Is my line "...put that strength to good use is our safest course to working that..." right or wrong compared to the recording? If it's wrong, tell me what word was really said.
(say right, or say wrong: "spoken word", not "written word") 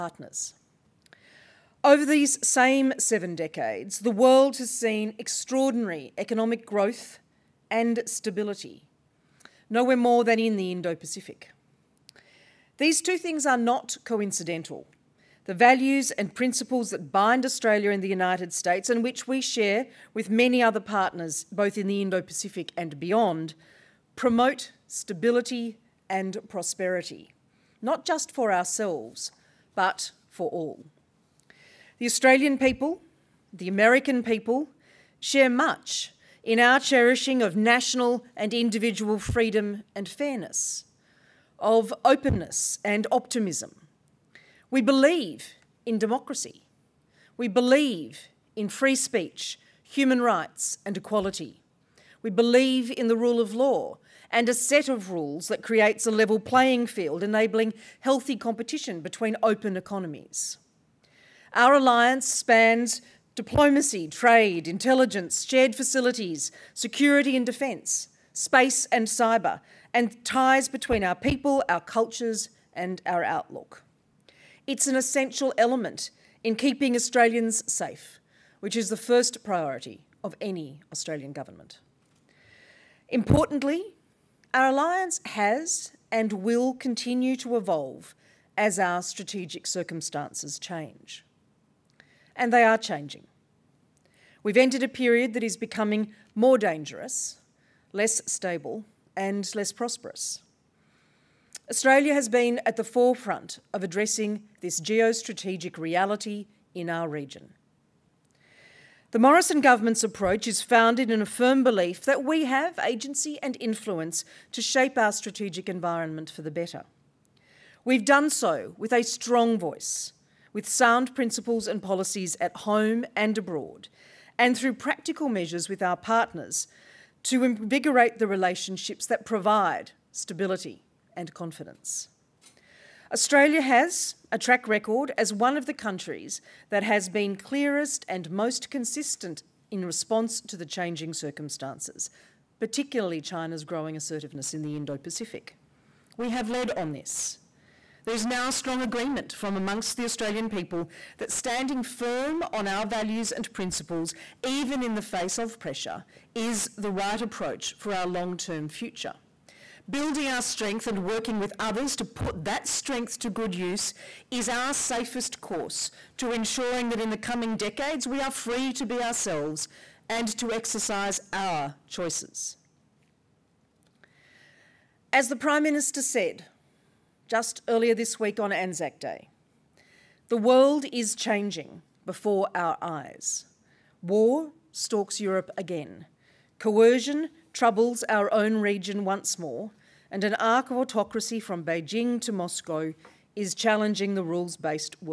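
wrong: "ensuring", not "working".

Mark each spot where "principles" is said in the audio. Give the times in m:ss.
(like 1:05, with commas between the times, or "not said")
0:16, 2:01, 2:33.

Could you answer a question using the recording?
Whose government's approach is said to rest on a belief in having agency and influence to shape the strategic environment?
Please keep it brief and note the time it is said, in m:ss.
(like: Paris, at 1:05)
Morrison, at 1:49.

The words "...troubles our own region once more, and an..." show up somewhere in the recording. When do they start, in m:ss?
3:07.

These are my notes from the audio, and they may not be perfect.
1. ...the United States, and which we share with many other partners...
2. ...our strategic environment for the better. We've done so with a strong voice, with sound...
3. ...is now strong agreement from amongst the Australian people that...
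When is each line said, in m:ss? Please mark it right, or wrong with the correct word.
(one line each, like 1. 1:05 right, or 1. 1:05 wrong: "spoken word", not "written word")
1. 0:18 right
2. 1:54 right
3. 2:28 right.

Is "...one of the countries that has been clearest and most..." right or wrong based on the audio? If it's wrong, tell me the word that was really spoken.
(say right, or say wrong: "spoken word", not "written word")
right.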